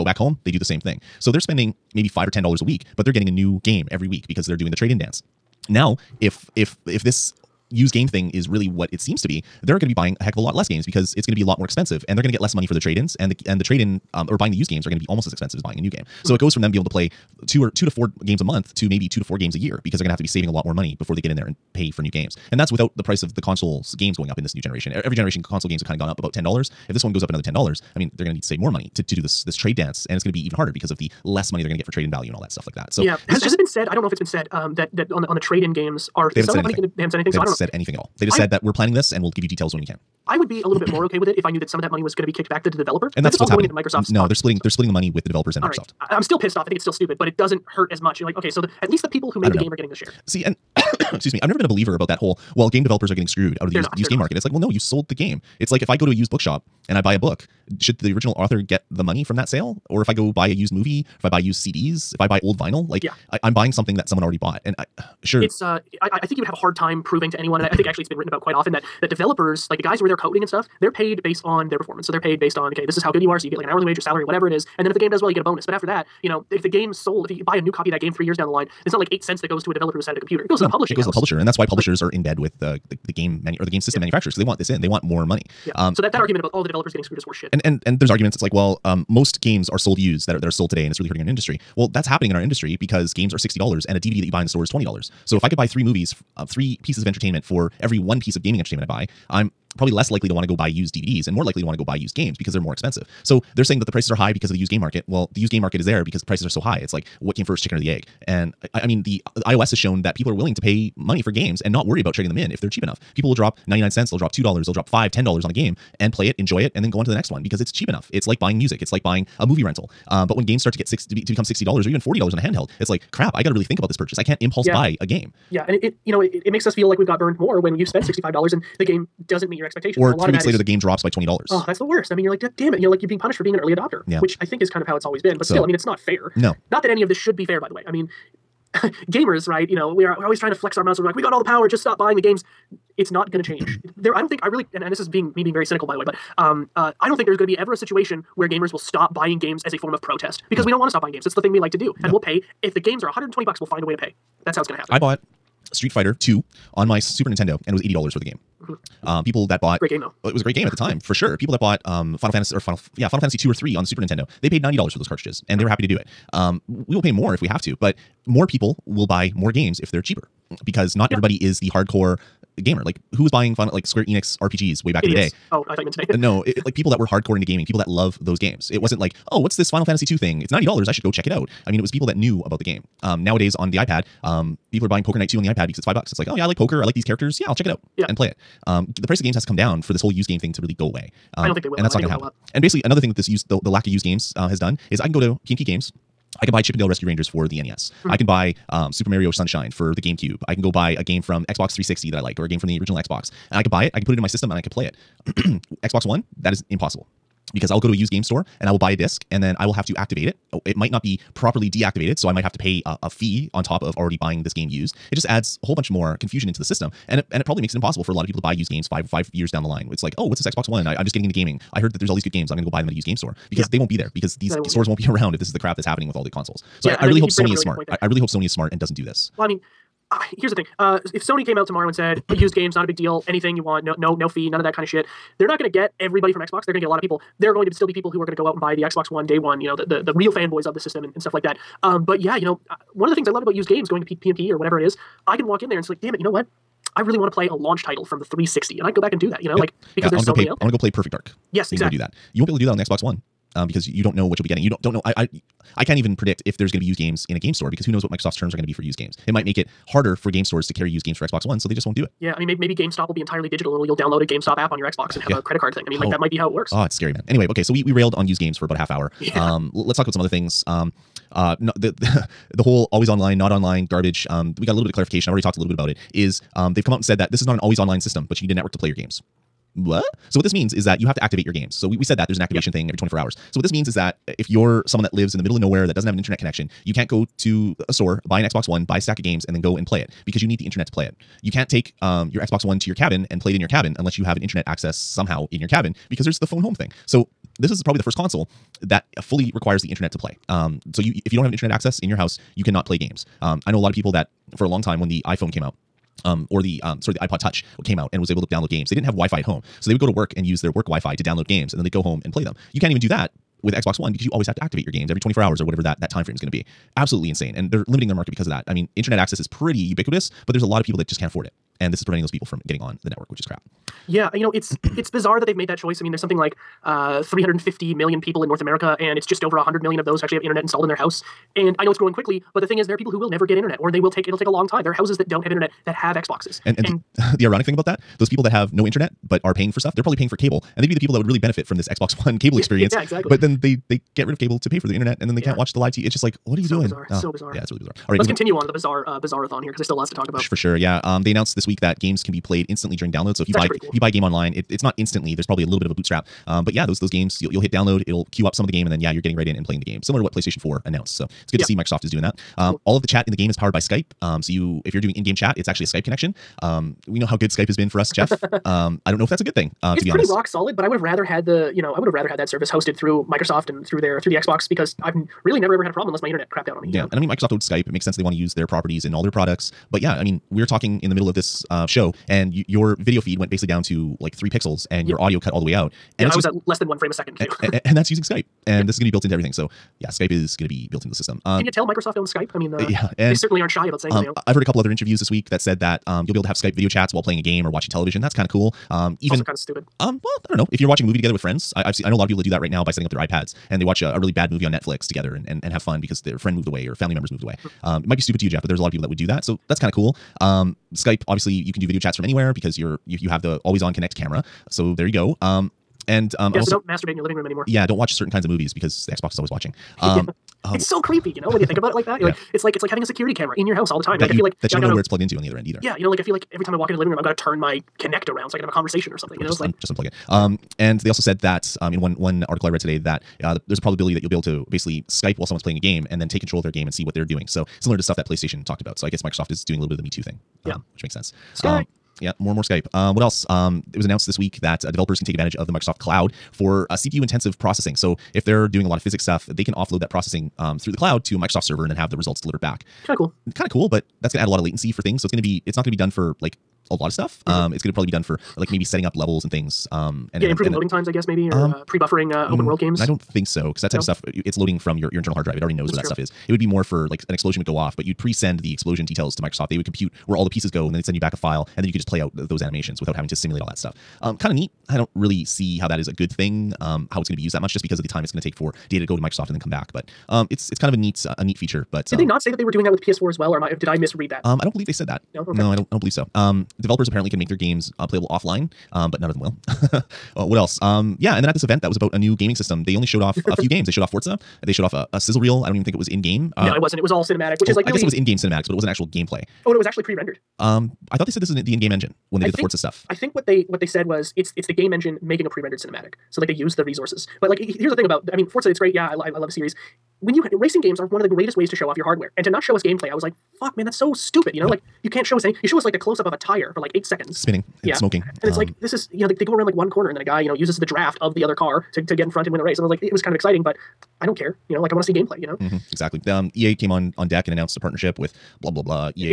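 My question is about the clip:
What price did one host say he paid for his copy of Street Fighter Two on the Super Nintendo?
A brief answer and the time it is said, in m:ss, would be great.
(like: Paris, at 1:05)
$80, at 2:37.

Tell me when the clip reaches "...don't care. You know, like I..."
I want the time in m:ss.
8:44.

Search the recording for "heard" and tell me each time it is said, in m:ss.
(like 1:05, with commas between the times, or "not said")
3:41, 6:34.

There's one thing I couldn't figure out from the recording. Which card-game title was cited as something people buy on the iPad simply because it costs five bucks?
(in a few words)
Poker Night 2.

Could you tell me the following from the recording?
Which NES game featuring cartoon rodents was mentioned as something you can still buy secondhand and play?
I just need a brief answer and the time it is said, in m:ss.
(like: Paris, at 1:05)
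Chippendale Rescue Rangers, at 3:16.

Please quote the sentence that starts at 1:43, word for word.
So they're saying that the prices are high because of the used game market.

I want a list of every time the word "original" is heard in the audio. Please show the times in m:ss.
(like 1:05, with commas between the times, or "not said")
0:58, 3:22.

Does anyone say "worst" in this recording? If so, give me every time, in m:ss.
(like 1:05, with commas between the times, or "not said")
2:11.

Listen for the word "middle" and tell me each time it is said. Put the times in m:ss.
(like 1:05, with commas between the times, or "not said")
4:45, 6:21.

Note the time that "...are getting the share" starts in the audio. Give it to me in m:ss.
0:49.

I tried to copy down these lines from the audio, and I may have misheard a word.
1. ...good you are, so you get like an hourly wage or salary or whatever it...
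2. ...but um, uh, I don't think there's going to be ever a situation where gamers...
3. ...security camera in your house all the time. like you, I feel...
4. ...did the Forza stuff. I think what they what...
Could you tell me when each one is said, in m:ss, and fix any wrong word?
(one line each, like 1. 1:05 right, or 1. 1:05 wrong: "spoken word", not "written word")
1. 1:13 right
2. 2:26 right
3. 7:03 right
4. 8:22 right.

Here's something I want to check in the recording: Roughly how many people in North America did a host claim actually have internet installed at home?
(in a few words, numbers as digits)
just over 100 million.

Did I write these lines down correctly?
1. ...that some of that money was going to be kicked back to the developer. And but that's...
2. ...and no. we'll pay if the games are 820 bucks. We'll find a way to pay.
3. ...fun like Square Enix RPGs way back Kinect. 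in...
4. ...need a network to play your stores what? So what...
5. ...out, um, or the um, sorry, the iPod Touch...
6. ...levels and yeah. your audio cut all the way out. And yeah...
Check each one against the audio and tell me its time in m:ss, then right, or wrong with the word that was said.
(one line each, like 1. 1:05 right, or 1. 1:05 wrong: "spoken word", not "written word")
1. 0:41 right
2. 2:32 wrong: "120", not "820"
3. 2:53 wrong: "Idiots", not "Kinect"
4. 4:38 wrong: "games", not "stores"
5. 5:05 right
6. 6:24 wrong: "pixels", not "levels".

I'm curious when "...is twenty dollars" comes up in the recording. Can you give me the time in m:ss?
1:34.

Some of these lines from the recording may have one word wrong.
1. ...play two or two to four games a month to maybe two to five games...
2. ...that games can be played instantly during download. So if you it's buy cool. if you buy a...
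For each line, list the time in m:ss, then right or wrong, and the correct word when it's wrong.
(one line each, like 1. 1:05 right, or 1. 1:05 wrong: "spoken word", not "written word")
1. 0:16 wrong: "four", not "five"
2. 5:51 right.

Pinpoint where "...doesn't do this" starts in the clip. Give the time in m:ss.
3:48.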